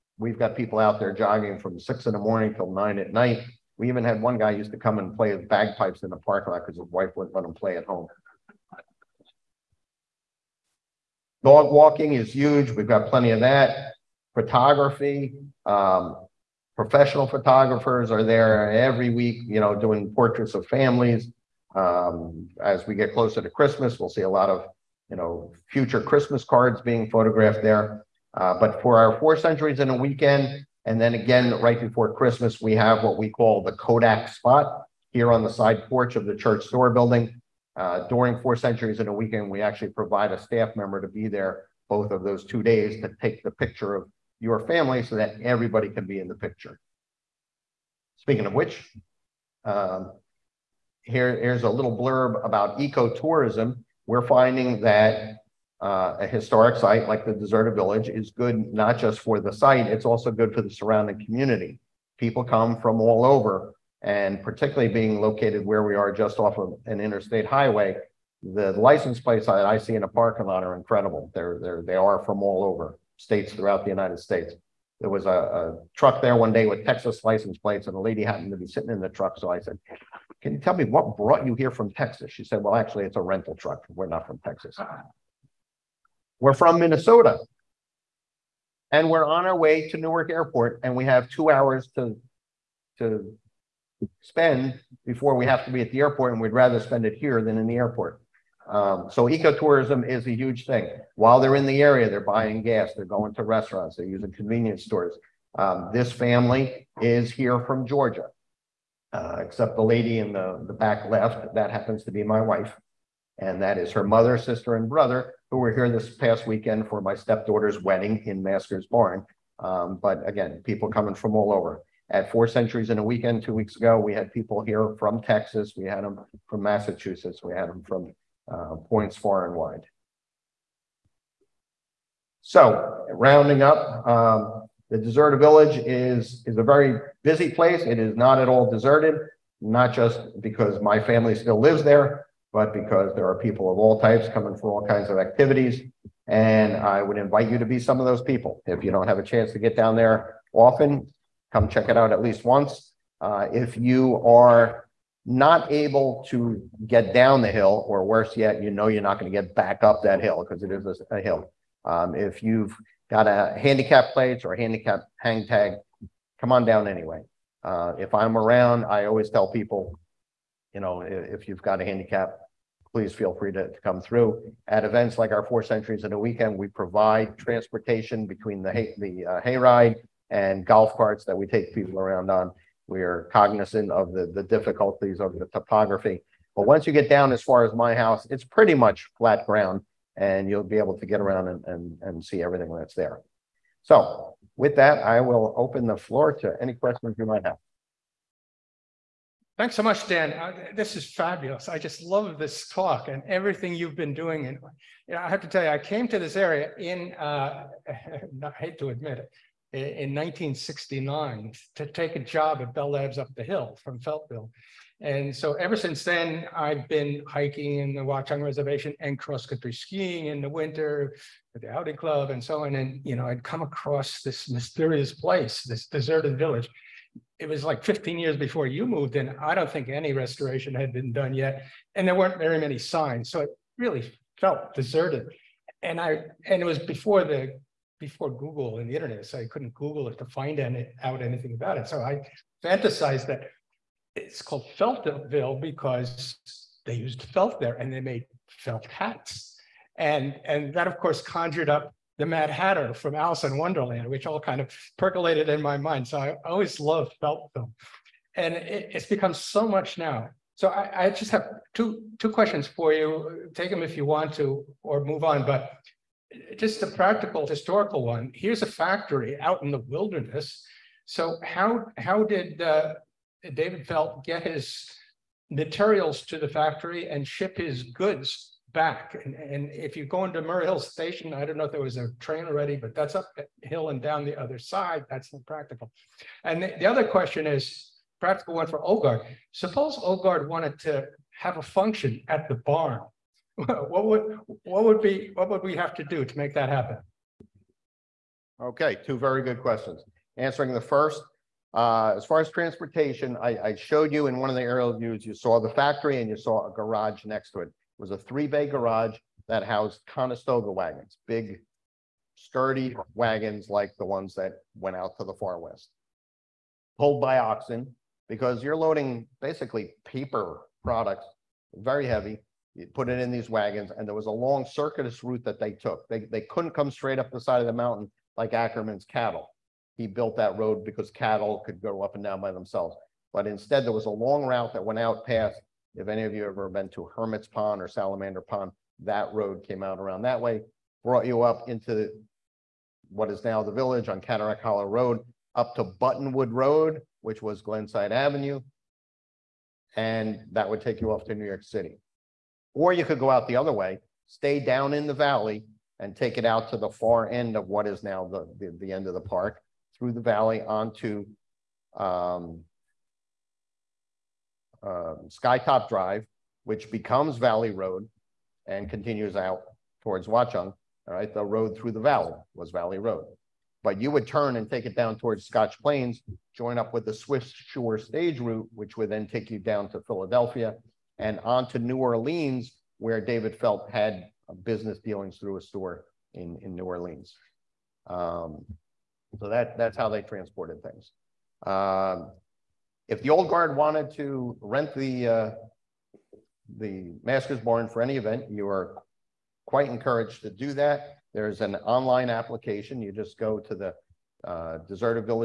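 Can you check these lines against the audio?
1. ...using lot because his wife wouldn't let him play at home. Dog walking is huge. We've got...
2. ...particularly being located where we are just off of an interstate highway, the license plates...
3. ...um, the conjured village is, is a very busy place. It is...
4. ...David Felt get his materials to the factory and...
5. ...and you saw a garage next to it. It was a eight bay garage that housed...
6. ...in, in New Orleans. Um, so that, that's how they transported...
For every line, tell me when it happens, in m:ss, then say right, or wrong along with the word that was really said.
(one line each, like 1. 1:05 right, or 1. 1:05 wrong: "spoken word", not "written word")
1. 0:06 wrong: "parking", not "using"
2. 1:04 right
3. 2:14 wrong: "deserted", not "conjured"
4. 4:33 right
5. 5:06 wrong: "three", not "eight"
6. 6:26 right.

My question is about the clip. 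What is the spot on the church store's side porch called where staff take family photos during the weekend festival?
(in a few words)
Kodak spot.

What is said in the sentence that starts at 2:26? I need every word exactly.
And I would invite you to be some of those people.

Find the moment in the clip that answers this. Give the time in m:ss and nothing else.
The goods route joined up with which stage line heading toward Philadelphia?
6:17.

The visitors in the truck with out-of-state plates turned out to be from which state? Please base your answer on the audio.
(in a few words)
Minnesota.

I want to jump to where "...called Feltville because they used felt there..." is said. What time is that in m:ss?
4:04.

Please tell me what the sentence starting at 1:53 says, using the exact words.
And that is her mother, sister, and brother, who were here this past weekend for my stepdaughter's wedding in Master's Barn.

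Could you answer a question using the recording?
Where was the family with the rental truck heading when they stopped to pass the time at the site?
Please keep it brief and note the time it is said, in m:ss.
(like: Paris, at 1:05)
Newark Airport, at 1:29.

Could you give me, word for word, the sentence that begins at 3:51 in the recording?
And there weren't very many signs.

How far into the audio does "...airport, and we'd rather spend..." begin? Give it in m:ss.
1:35.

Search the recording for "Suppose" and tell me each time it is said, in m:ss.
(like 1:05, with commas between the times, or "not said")
4:49.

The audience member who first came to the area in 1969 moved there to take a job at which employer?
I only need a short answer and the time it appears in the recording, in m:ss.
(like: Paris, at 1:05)
Bell Labs, at 3:32.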